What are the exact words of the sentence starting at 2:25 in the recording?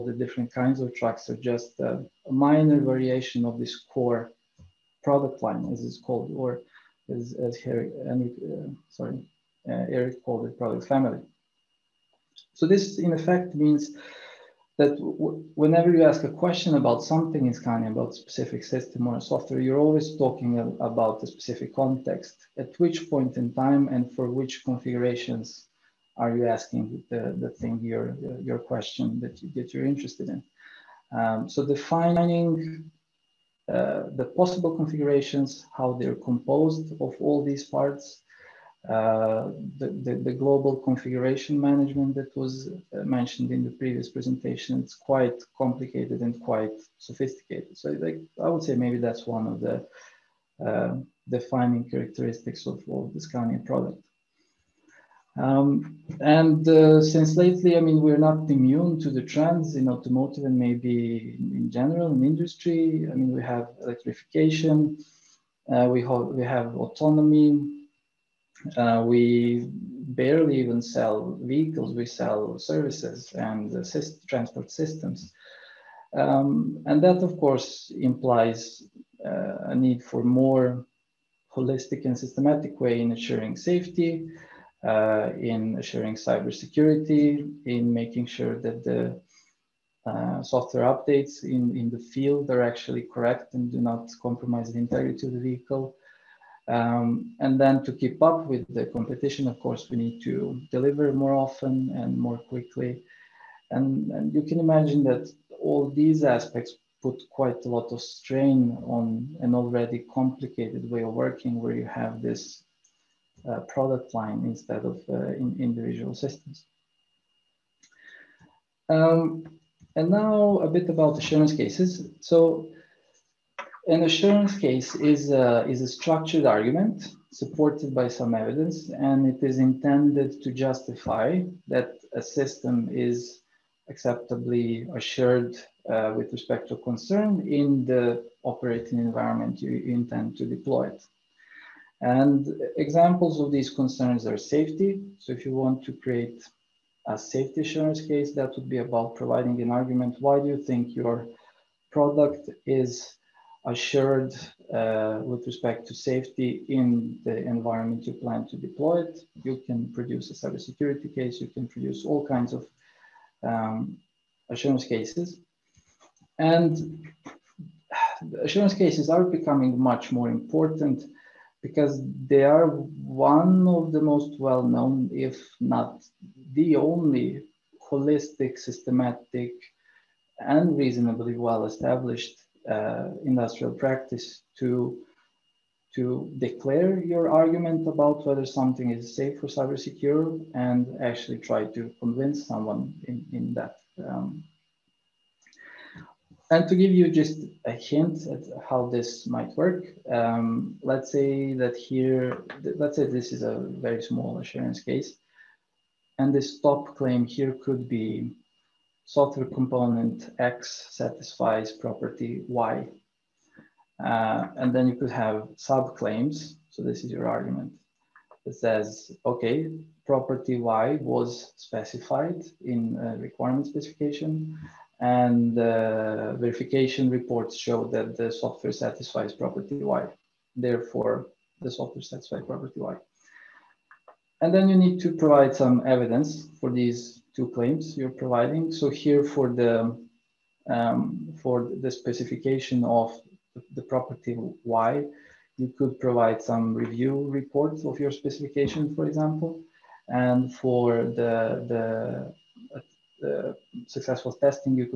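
So if you want to create a safety assurance case, that would be about providing an argument.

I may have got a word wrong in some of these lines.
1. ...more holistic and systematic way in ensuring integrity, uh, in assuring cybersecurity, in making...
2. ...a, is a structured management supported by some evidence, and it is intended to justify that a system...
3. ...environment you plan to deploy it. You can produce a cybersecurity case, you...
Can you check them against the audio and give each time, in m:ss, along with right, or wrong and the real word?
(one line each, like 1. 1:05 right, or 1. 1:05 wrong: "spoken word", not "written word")
1. 1:20 wrong: "safety", not "integrity"
2. 2:05 wrong: "argument", not "management"
3. 2:37 right.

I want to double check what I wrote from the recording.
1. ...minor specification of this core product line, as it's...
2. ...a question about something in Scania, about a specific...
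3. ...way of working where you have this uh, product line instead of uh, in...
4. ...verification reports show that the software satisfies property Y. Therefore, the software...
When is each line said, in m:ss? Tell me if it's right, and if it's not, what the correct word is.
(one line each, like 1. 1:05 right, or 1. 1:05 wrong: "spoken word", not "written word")
1. 0:02 wrong: "variation", not "specification"
2. 0:16 right
3. 1:50 right
4. 3:46 right.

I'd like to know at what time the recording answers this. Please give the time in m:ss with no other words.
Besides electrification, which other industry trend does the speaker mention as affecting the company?
1:06.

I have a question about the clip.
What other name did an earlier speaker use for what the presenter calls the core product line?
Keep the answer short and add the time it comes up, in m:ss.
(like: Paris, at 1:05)
Product family, at 0:10.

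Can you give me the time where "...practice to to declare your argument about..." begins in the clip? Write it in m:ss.
3:03.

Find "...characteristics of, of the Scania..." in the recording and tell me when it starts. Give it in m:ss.
0:51.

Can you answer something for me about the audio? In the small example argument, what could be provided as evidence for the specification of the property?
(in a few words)
Review reports.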